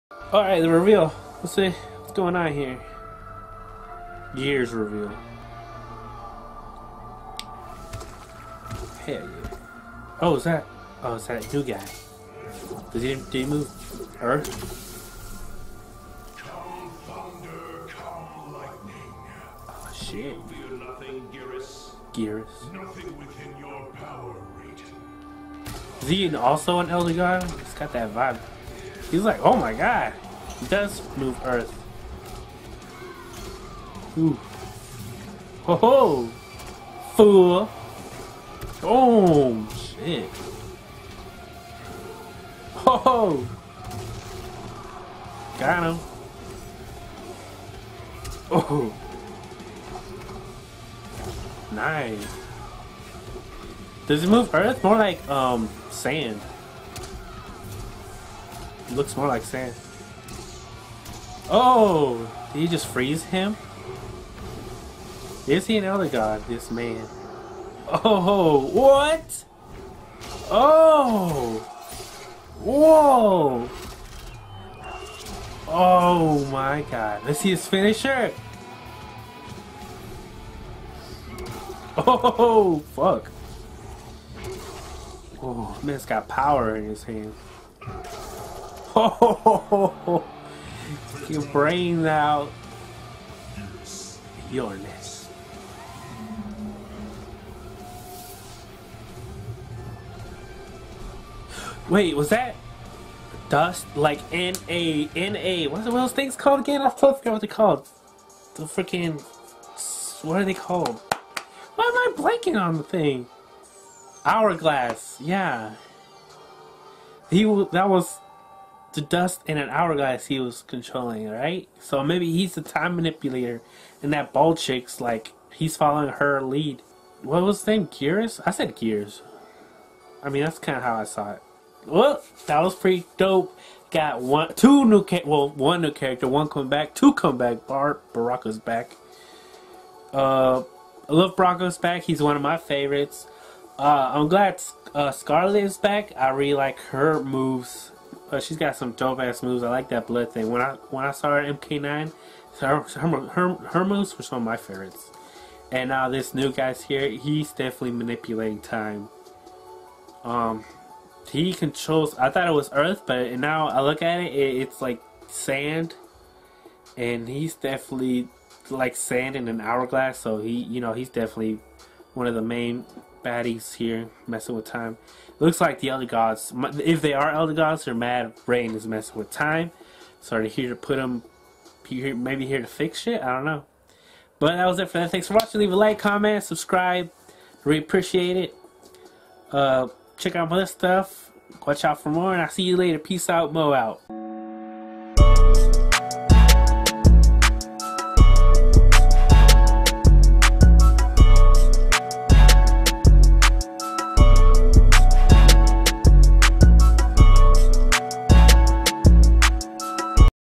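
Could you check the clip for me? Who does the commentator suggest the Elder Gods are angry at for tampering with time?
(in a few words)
Rain.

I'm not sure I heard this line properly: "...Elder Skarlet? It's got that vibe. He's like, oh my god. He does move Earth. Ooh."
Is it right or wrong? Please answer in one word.
wrong.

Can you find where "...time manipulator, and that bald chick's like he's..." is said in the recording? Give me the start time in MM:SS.
02:02.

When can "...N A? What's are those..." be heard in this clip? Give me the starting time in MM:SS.
01:45.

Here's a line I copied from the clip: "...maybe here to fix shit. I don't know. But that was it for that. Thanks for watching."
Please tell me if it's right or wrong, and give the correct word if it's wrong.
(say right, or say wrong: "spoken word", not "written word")
right.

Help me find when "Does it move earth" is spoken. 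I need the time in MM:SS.
00:54.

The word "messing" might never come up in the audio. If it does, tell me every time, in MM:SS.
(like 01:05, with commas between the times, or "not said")
02:54, 02:58.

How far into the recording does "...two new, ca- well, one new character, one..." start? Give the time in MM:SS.
02:14.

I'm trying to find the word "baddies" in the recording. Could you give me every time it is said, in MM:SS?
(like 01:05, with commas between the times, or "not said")
02:53.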